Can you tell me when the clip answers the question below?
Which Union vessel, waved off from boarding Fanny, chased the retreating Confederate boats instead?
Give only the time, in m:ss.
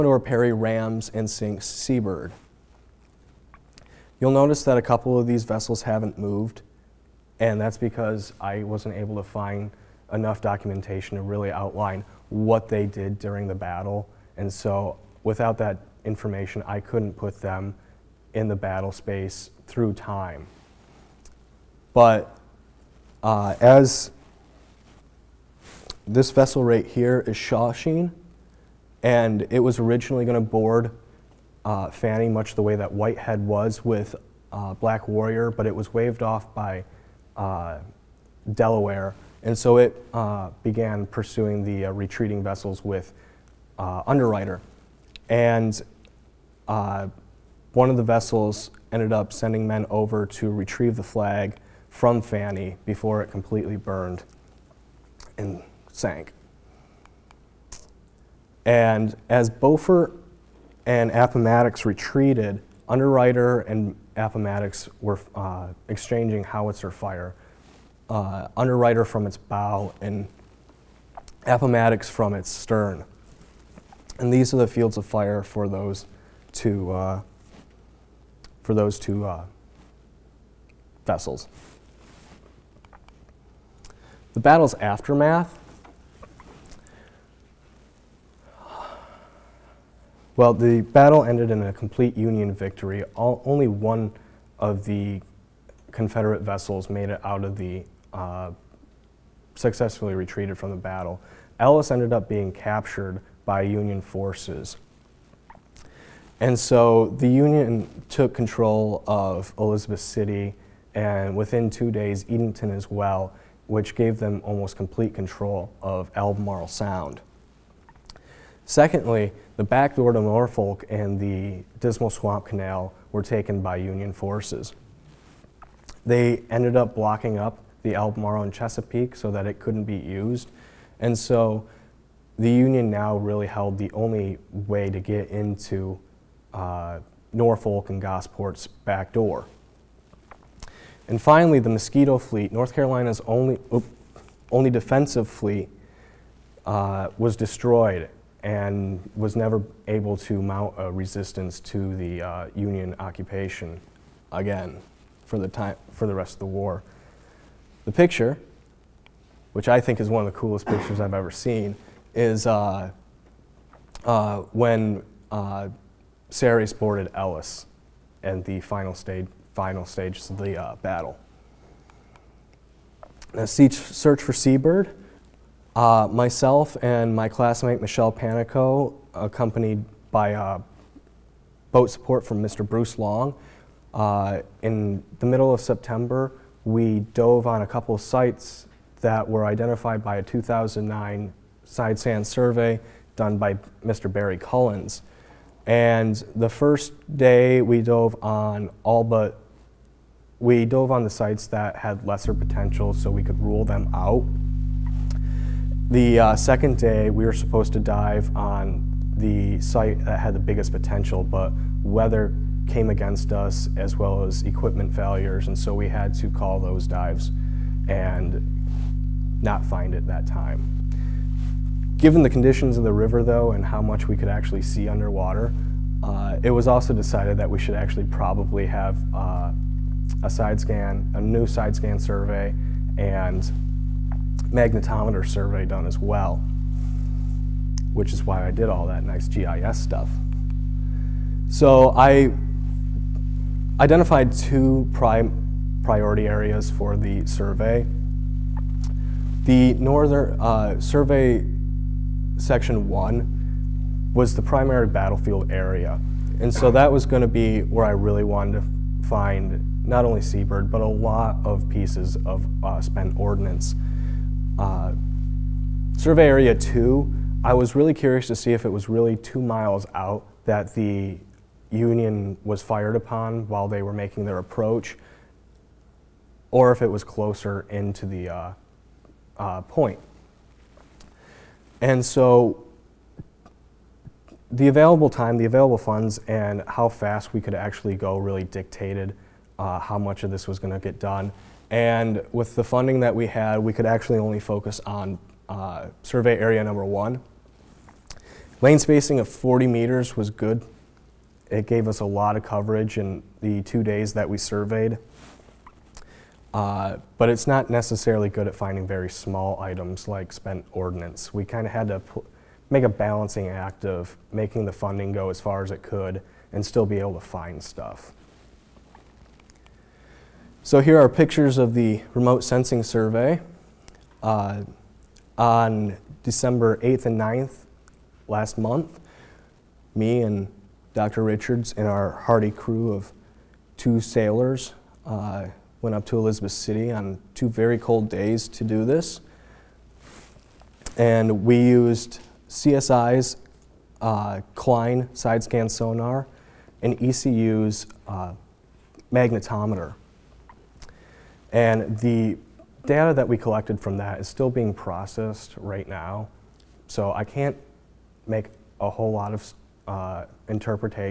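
0:27.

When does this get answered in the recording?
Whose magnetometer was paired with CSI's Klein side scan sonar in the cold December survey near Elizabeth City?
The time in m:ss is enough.
5:47.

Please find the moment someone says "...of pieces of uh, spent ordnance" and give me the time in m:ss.
4:21.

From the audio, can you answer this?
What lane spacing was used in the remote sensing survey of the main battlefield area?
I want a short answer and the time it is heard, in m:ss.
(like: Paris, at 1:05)
40 meters, at 4:59.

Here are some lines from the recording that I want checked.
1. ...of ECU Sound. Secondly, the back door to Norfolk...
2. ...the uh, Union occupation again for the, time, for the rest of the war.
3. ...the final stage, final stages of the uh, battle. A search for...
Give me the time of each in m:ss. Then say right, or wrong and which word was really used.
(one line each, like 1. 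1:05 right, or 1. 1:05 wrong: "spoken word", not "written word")
1. 1:55 wrong: "Albemarle", not "ECU"
2. 2:31 right
3. 2:48 right.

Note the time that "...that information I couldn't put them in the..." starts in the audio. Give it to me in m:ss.
0:15.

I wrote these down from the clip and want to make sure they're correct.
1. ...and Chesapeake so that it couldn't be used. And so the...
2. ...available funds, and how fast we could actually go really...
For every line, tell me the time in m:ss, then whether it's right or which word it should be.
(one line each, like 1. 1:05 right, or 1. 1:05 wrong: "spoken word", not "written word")
1. 2:08 right
2. 4:45 right.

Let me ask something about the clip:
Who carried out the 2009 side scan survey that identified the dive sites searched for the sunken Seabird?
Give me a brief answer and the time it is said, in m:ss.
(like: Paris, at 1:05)
Barry Collins, at 3:13.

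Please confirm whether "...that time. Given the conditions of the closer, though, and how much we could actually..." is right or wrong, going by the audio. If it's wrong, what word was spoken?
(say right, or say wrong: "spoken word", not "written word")
wrong: "river", not "closer".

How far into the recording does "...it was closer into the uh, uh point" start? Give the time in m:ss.
4:36.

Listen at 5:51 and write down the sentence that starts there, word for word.
And the data that we collected from that is still being processed right now.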